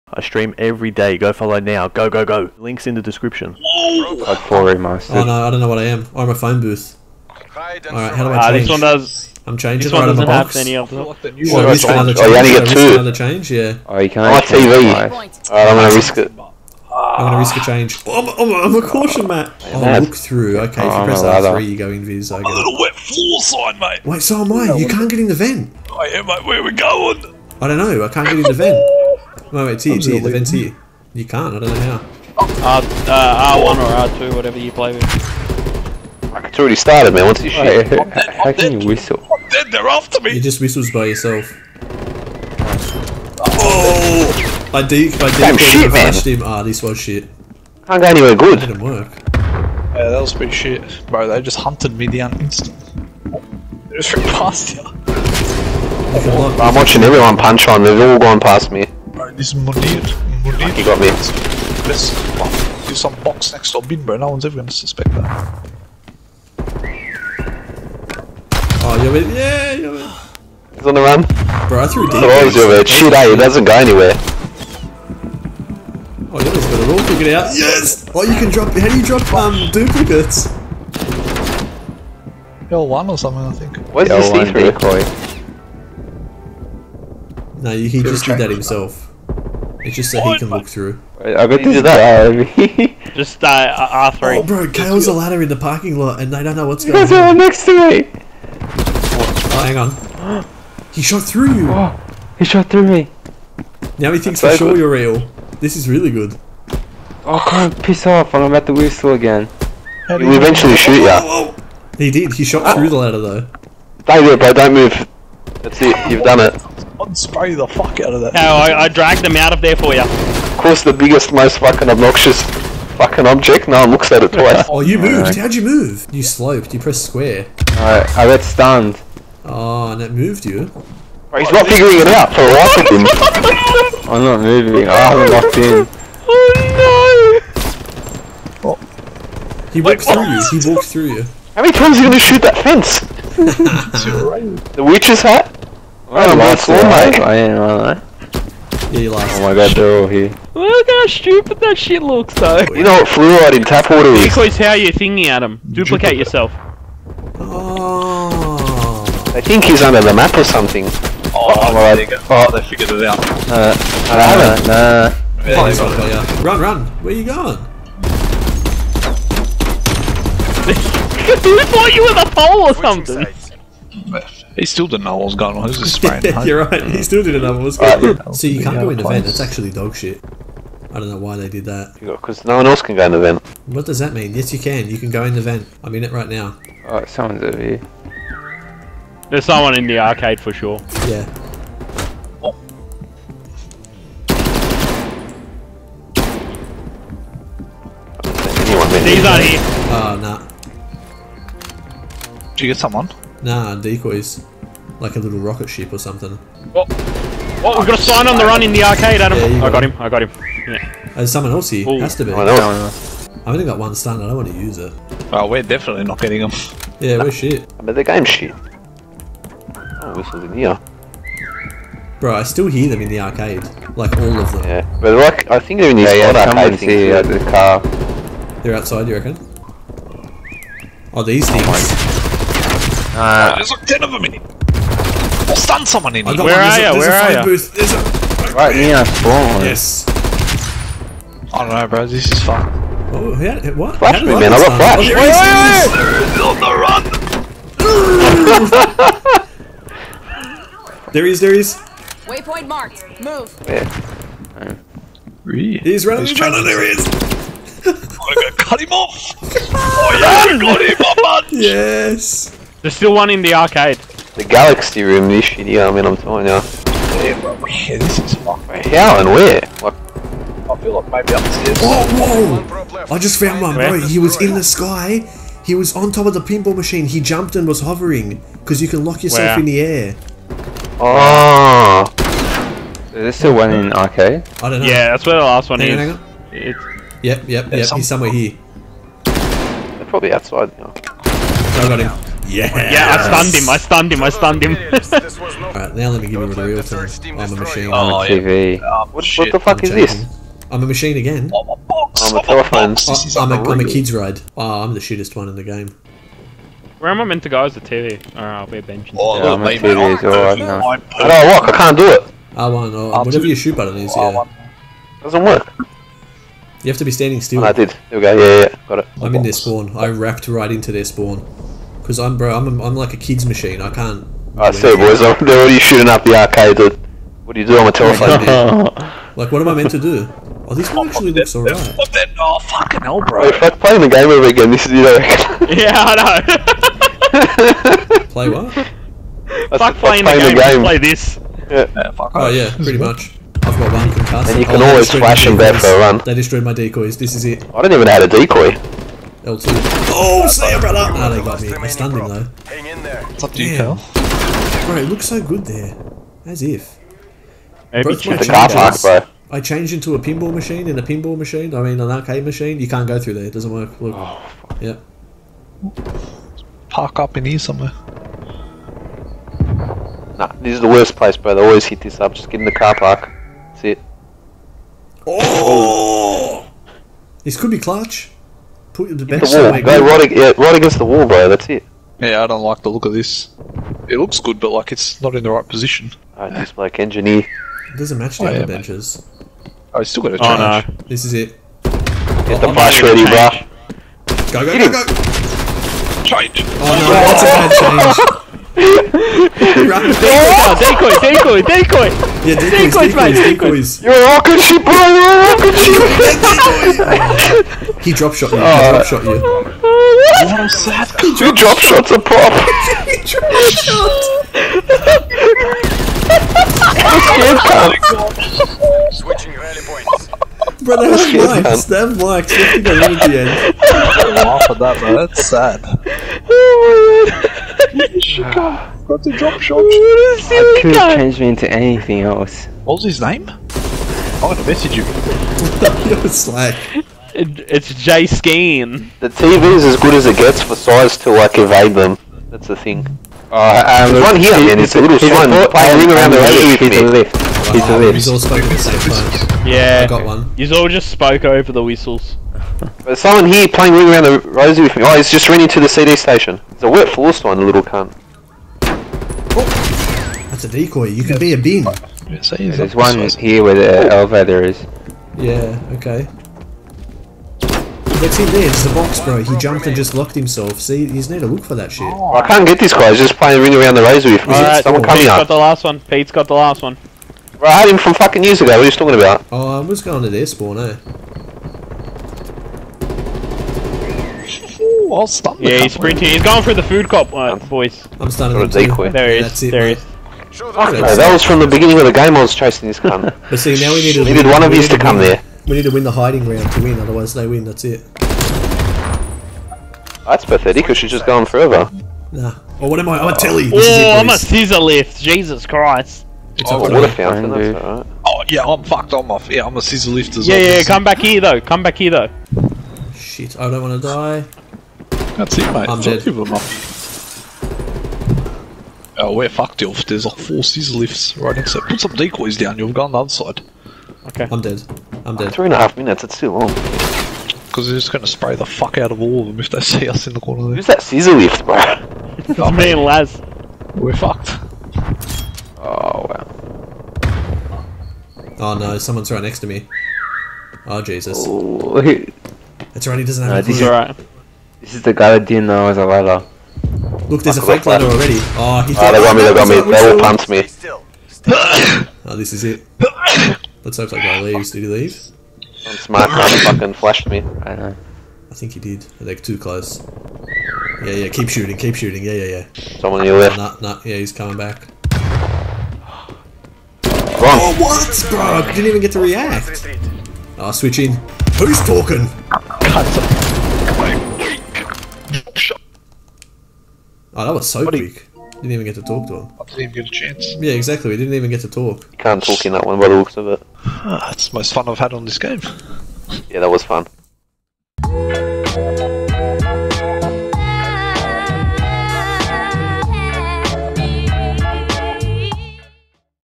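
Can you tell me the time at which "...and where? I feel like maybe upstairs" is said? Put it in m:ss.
4:29.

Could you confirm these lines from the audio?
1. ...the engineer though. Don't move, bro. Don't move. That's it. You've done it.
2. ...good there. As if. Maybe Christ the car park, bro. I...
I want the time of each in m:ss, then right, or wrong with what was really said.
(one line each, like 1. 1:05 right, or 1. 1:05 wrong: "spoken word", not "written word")
1. 1:52 wrong: "ladder", not "engineer"
2. 5:55 wrong: "Broke", not "Christ".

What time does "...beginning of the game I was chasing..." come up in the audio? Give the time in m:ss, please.
8:11.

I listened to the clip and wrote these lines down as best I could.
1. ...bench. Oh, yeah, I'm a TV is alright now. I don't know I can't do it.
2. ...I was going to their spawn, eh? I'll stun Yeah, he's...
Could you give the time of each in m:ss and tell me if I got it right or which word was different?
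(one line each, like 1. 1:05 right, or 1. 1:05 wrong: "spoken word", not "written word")
1. 5:08 right
2. 7:59 right.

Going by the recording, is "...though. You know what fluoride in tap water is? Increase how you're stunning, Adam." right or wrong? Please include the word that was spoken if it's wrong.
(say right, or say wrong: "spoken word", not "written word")
wrong: "thinking", not "stunning".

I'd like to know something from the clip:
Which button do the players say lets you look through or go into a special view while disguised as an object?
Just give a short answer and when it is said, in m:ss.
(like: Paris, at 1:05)
R3, at 0:21.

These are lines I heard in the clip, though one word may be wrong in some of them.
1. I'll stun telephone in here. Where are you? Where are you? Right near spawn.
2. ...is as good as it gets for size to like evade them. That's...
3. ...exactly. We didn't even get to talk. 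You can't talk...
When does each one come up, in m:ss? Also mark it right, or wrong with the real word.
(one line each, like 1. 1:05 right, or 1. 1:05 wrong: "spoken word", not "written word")
1. 3:54 wrong: "someone", not "telephone"
2. 7:19 right
3. 9:40 right.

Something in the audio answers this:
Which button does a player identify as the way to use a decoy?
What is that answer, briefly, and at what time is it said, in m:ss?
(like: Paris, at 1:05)
L2, at 5:49.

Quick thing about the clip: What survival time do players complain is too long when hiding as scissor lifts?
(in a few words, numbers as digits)
3.5 minutes.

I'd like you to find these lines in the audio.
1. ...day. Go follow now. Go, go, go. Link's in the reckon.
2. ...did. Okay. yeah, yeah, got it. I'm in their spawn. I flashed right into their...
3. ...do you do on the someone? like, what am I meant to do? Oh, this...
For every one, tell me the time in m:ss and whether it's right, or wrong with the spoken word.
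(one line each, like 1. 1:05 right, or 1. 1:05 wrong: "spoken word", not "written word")
1. 0:00 wrong: "description", not "reckon"
2. 5:17 wrong: "wrapped", not "flashed"
3. 5:27 wrong: "telephone", not "someone".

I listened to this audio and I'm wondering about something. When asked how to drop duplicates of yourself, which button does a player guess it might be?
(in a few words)
L1.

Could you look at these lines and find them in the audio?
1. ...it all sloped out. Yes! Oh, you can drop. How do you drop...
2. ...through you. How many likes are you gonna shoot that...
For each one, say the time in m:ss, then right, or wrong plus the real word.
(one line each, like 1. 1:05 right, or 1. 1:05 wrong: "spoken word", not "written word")
1. 1:16 wrong: "figured", not "sloped"
2. 2:20 wrong: "times", not "likes".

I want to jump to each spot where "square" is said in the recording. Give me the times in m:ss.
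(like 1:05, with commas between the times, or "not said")
2:07.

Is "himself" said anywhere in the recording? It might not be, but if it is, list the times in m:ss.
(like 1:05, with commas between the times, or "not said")
1:28, 7:50.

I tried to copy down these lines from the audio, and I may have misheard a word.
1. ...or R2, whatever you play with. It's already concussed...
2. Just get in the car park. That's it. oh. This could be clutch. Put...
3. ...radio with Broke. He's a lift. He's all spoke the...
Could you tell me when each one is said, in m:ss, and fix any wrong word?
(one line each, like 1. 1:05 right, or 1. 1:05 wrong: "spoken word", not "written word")
1. 0:33 wrong: "started", not "concussed"
2. 6:12 right
3. 7:26 wrong: "Lift", not "Broke".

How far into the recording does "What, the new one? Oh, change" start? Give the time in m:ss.
0:11.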